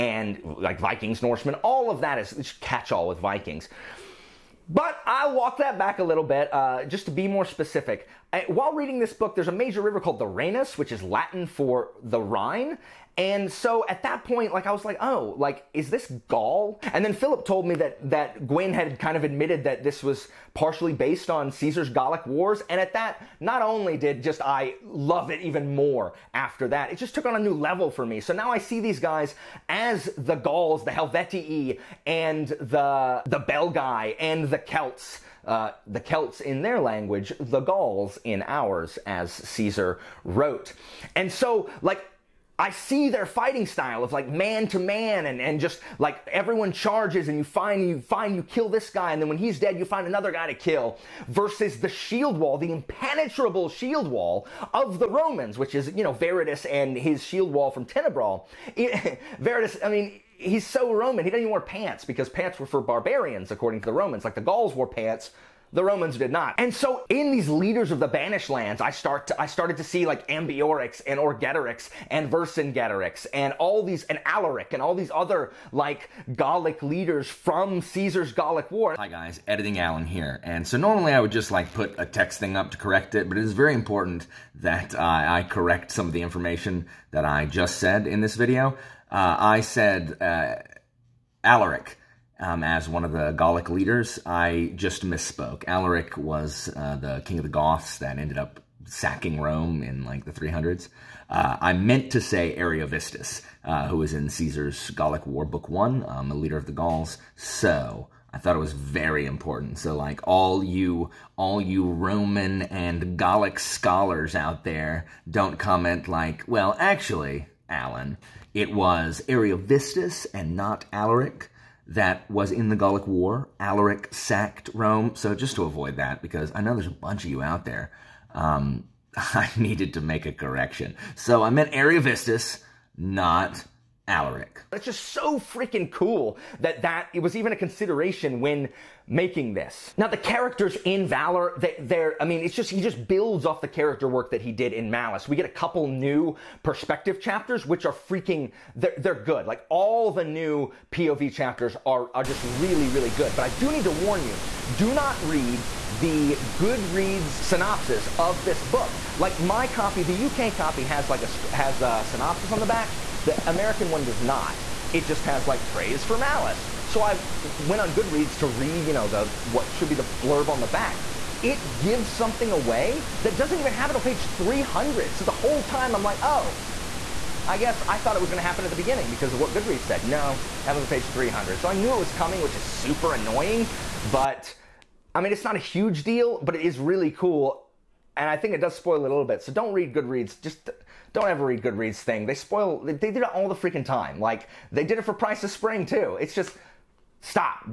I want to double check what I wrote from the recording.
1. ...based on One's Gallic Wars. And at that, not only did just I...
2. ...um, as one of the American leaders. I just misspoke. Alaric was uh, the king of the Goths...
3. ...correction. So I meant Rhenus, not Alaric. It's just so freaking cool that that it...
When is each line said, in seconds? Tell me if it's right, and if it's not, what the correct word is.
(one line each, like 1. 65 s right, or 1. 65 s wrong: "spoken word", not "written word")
1. 20 s wrong: "Caesar", not "One"
2. 92 s wrong: "Gallic", not "American"
3. 130 s wrong: "Ariovistus", not "Rhenus".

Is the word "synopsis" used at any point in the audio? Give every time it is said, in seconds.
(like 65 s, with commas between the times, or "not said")
157 s, 162 s.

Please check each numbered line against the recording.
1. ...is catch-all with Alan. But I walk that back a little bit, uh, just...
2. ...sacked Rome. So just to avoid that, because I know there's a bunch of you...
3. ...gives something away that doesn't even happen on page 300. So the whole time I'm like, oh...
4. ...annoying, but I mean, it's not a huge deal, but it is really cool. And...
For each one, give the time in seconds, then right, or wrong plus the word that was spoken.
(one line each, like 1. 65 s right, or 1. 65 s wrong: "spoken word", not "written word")
1. 2 s wrong: "Vikings", not "Alan"
2. 124 s right
3. 171 s right
4. 183 s right.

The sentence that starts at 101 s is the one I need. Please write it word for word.
Uh, I meant to say Ariovistus, uh, who was in Caesar's Gallic War, Book One, um, a leader of the Gauls.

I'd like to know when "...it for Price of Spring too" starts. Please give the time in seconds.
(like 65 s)
194 s.